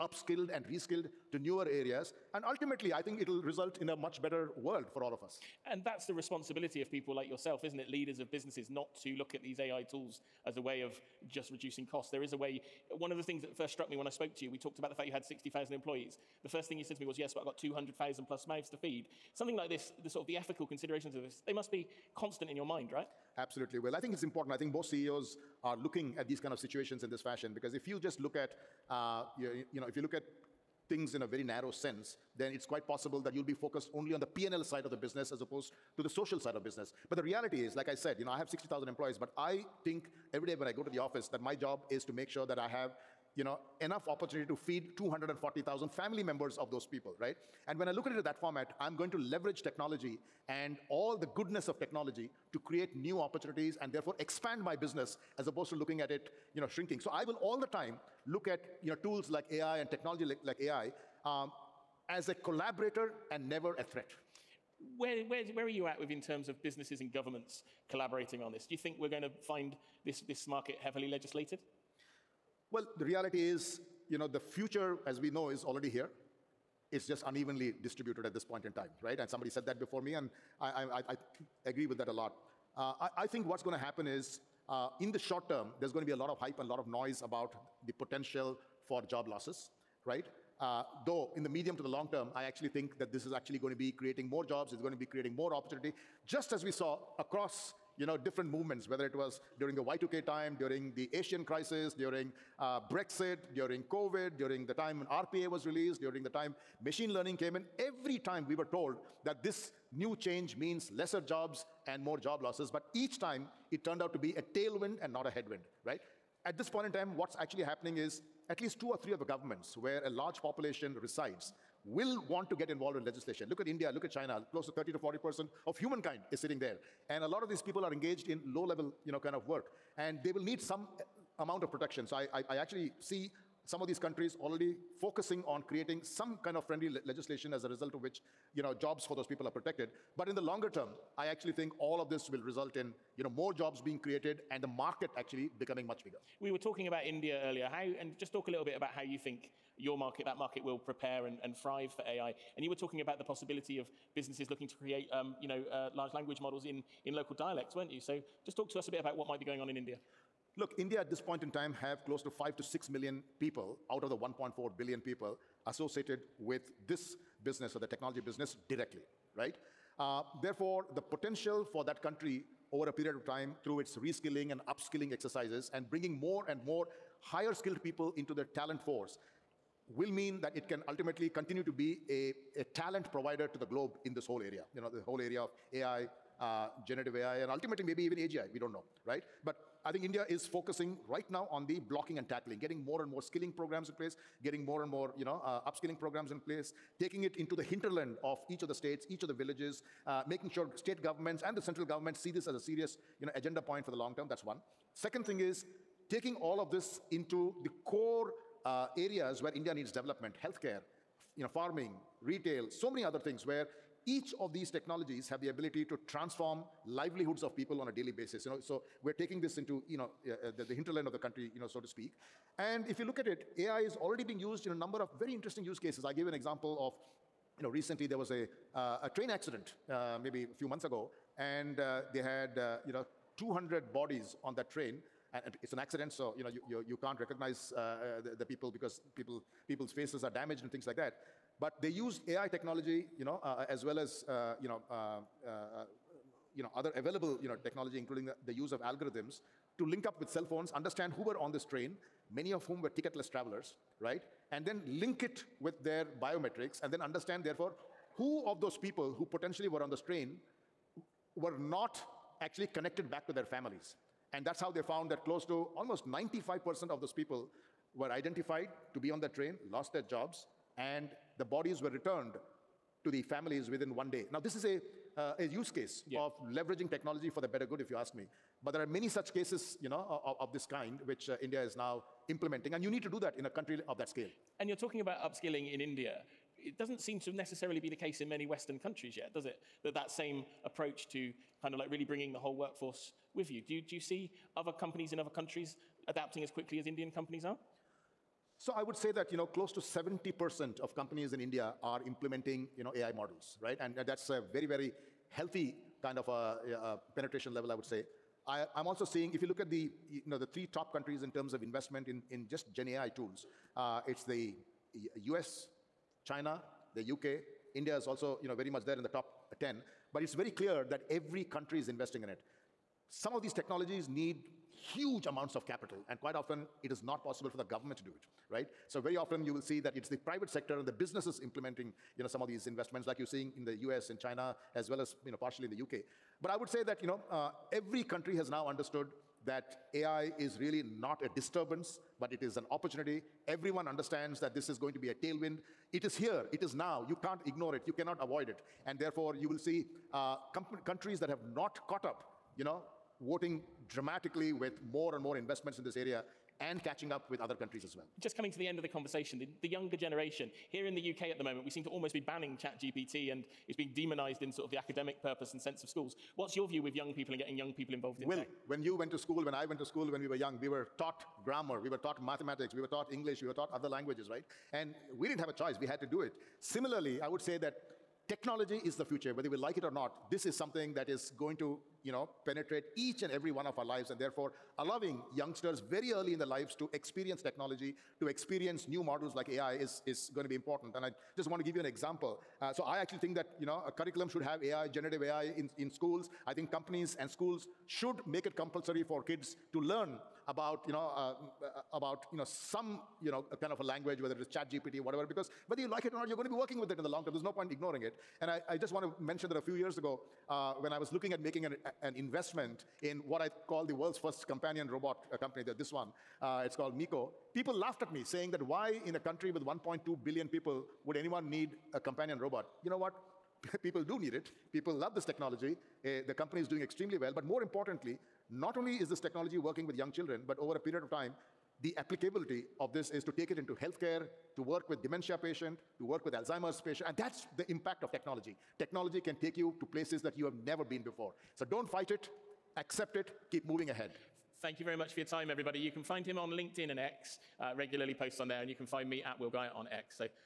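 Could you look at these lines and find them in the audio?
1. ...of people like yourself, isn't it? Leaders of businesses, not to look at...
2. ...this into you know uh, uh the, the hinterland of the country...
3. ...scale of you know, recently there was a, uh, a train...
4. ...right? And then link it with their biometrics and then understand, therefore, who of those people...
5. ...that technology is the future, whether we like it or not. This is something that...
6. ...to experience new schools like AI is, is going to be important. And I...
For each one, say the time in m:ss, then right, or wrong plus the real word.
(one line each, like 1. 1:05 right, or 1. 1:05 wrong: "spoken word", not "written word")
1. 0:06 right
2. 3:39 right
3. 3:46 wrong: "example", not "scale"
4. 4:13 right
5. 6:17 right
6. 6:28 wrong: "models", not "schools".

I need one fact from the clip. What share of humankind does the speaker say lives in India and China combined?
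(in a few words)
30 to 40%.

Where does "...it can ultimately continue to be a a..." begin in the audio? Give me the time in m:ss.
3:00.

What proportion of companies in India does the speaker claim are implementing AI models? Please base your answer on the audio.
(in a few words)
70%.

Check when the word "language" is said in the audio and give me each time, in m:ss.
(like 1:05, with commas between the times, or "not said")
2:36, 6:13, 6:43.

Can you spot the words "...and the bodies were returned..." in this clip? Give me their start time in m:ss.
4:30.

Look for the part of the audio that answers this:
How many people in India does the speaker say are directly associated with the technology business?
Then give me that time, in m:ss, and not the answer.
2:42.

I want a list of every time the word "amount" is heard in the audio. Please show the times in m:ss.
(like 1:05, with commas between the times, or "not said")
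2:11, 5:25.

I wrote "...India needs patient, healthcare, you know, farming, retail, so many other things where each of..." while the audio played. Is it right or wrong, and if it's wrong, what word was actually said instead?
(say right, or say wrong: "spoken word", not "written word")
wrong: "development", not "patient".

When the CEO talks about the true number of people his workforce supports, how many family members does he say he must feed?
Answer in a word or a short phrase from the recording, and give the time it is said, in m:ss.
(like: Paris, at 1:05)
240,000, at 0:44.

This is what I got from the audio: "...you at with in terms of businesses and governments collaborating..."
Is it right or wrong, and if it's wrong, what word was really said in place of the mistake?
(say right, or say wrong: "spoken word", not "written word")
right.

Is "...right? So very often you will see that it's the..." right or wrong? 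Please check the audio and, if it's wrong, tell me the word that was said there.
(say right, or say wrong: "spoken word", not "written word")
right.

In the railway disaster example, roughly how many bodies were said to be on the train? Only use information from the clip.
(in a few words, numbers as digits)
200.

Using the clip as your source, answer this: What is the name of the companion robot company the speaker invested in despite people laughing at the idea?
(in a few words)
Miko.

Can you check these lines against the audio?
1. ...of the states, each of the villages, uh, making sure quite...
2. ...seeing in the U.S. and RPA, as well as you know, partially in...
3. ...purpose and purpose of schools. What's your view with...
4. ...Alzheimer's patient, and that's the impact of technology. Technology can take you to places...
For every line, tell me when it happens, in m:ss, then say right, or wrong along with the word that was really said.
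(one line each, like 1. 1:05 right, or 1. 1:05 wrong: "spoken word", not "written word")
1. 3:18 wrong: "state", not "quite"
2. 5:33 wrong: "China", not "RPA"
3. 6:05 wrong: "sense", not "purpose"
4. 7:16 right.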